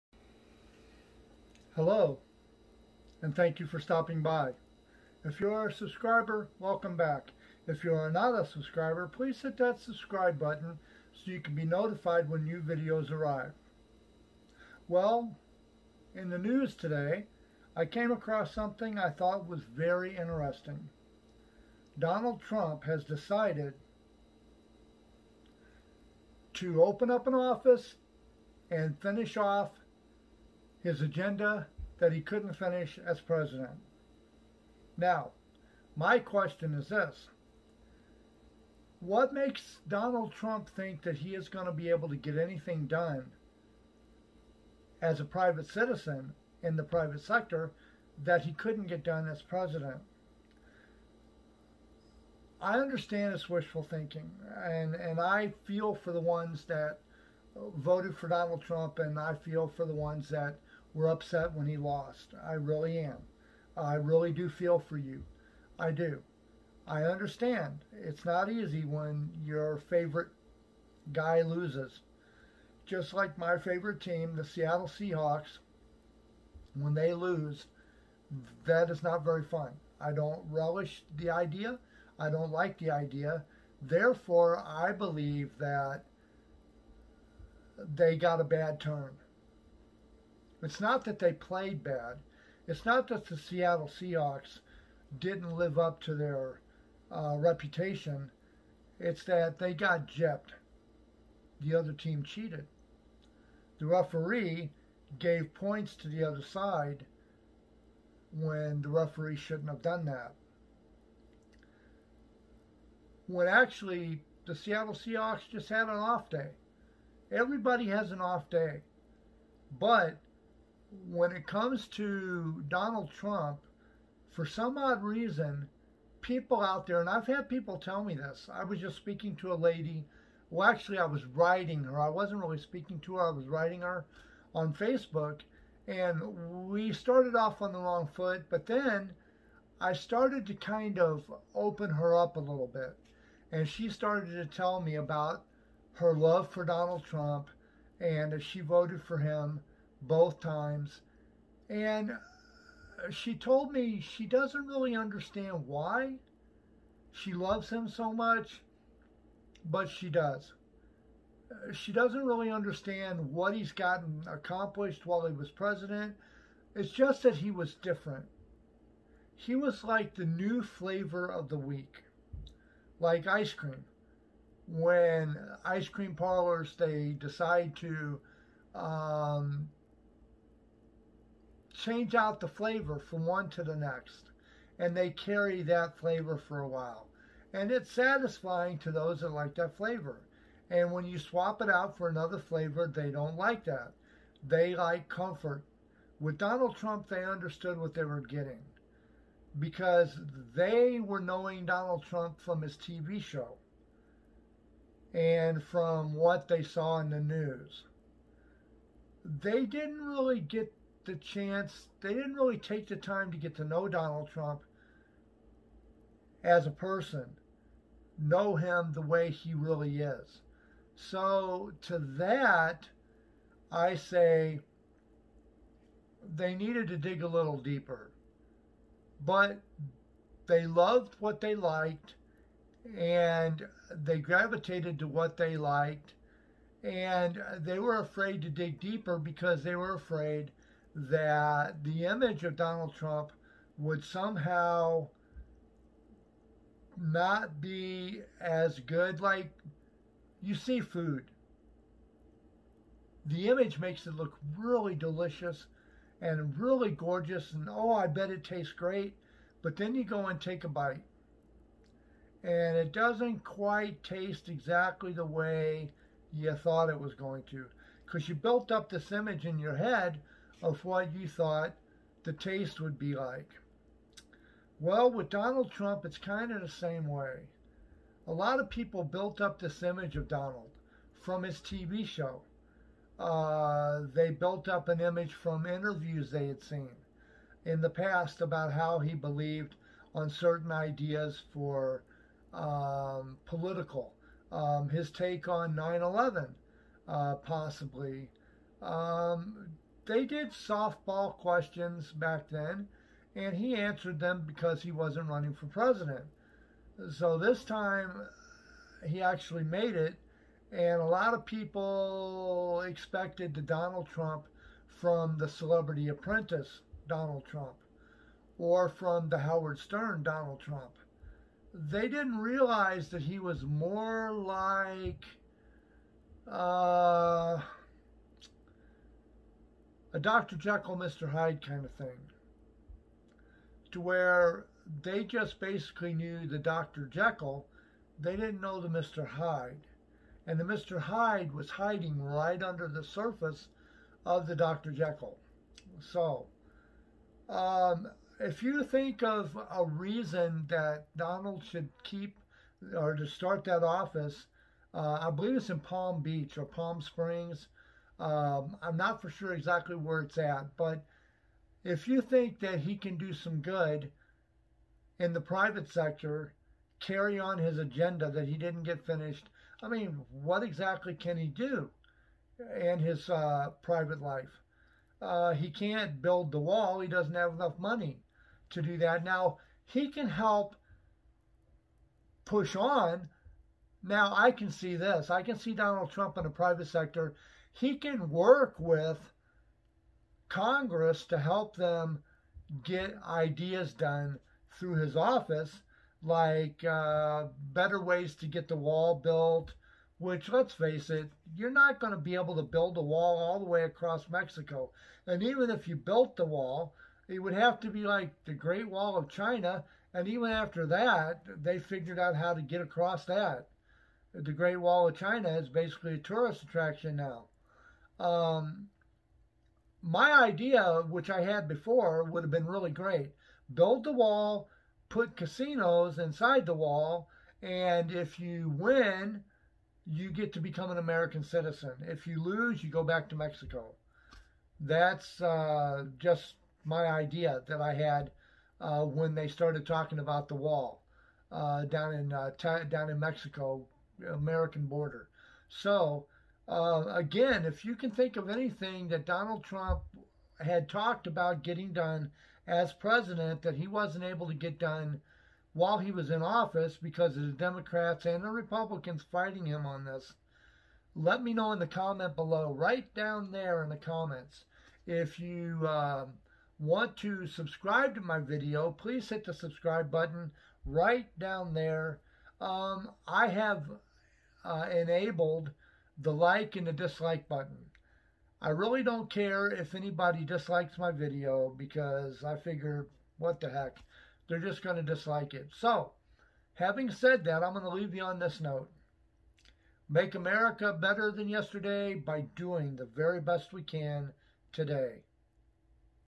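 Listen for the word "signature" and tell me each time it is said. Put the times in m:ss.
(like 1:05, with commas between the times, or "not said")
not said.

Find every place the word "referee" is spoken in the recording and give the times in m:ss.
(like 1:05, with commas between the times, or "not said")
1:43, 1:48.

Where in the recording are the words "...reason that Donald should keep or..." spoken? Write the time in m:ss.
5:49.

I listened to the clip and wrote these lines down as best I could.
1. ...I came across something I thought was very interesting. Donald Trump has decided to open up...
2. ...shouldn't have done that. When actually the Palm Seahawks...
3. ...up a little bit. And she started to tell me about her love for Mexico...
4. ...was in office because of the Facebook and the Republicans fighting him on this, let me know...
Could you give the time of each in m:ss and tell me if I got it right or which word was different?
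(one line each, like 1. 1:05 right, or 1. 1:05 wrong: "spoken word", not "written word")
1. 0:17 right
2. 1:49 wrong: "Seattle", not "Palm"
3. 2:22 wrong: "Donald", not "Mexico"
4. 7:36 wrong: "Democrats", not "Facebook".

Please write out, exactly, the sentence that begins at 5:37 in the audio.
Jekyll, they didn't know the Mr.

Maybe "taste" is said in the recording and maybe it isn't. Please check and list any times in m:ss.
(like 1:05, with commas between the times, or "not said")
4:18, 4:24, 4:32.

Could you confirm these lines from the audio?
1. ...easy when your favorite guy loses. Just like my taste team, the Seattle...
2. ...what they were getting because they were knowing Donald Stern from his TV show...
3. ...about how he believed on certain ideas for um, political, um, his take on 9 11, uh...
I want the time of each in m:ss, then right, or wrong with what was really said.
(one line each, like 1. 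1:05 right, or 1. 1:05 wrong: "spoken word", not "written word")
1. 1:08 wrong: "favorite", not "taste"
2. 3:17 wrong: "Trump", not "Stern"
3. 4:48 right.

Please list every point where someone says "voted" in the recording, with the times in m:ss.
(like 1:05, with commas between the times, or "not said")
0:57, 2:28.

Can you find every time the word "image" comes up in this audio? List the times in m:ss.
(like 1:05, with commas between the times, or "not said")
4:02, 4:13, 4:29, 4:39, 4:45.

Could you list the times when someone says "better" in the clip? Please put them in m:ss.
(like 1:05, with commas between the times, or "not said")
6:37, 8:10.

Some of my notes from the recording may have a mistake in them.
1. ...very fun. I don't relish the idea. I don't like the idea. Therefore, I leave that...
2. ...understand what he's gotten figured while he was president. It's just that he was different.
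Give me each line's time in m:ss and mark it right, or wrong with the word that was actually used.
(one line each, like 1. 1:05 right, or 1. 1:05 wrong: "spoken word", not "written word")
1. 1:19 wrong: "believe", not "leave"
2. 2:42 wrong: "accomplished", not "figured".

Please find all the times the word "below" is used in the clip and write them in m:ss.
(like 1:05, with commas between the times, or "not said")
7:42.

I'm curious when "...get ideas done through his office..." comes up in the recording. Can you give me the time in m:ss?
6:32.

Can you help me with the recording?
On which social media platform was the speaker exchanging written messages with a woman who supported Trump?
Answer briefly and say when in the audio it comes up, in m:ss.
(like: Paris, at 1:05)
Facebook, at 2:14.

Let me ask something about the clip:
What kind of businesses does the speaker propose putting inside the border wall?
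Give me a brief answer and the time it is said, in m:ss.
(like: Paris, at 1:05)
Casinos, at 7:05.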